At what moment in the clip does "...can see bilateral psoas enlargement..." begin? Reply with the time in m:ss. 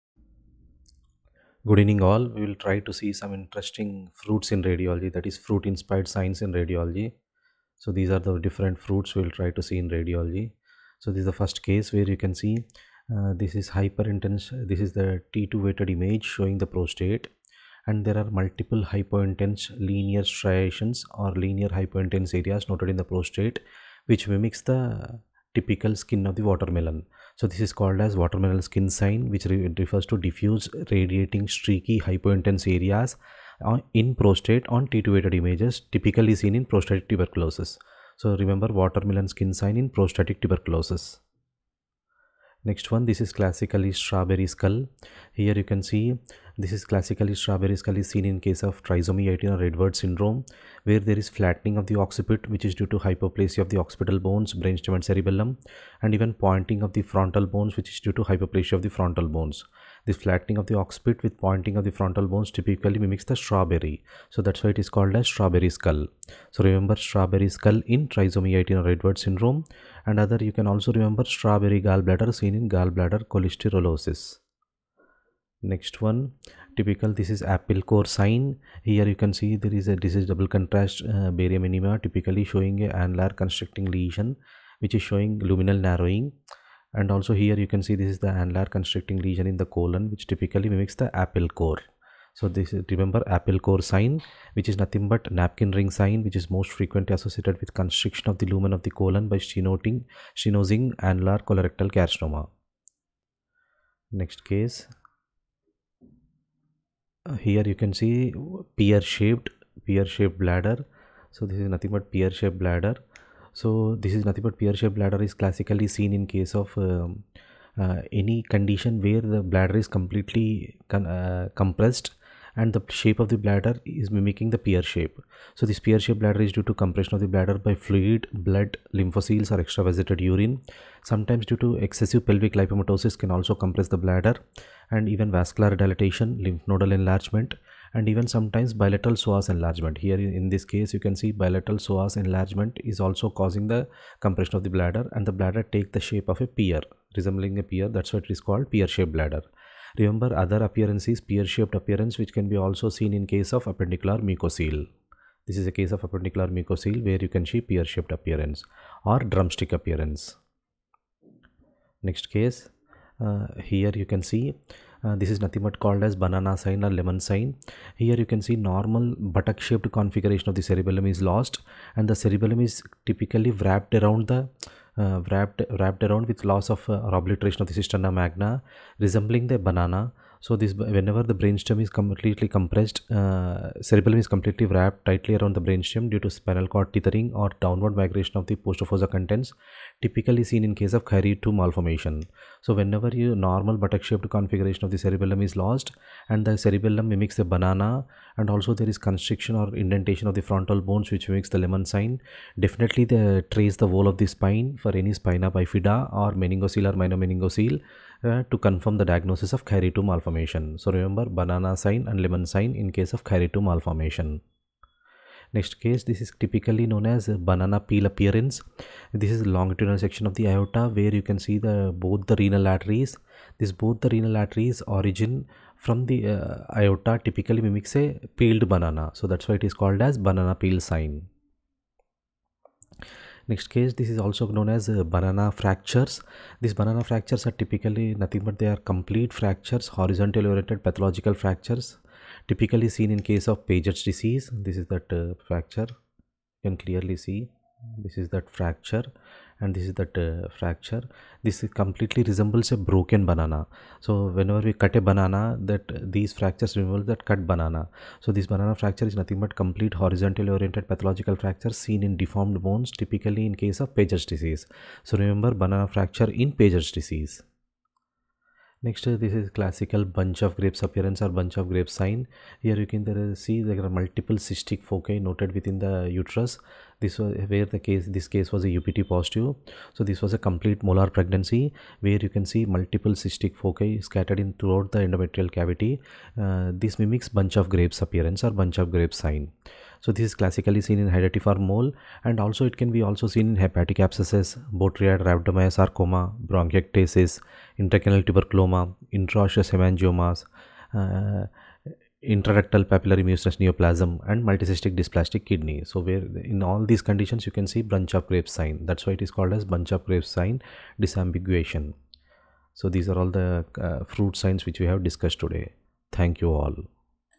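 2:21.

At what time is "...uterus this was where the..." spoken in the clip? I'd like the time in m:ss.
4:36.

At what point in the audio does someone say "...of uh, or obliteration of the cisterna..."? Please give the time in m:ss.
2:56.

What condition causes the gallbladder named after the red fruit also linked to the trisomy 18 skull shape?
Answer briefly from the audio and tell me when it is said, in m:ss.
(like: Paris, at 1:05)
Gallbladder cholesterolosis, at 1:12.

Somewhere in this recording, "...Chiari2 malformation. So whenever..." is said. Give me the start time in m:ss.
3:11.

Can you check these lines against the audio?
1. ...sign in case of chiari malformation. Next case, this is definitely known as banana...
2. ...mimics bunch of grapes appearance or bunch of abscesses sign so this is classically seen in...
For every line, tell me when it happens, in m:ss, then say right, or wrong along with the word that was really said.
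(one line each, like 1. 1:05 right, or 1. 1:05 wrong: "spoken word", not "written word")
1. 3:32 wrong: "typically", not "definitely"
2. 4:46 wrong: "grapes", not "abscesses".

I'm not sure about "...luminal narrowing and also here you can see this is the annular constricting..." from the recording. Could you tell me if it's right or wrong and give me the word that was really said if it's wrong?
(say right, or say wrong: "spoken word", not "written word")
right.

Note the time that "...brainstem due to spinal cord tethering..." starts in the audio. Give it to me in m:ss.
3:05.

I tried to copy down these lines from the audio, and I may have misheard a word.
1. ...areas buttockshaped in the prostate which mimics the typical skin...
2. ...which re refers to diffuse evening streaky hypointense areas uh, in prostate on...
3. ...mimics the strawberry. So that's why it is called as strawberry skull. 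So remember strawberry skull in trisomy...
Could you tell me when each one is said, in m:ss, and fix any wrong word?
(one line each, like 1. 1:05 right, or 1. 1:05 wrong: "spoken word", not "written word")
1. 0:22 wrong: "noted", not "buttockshaped"
2. 0:29 wrong: "radiating", not "evening"
3. 1:02 right.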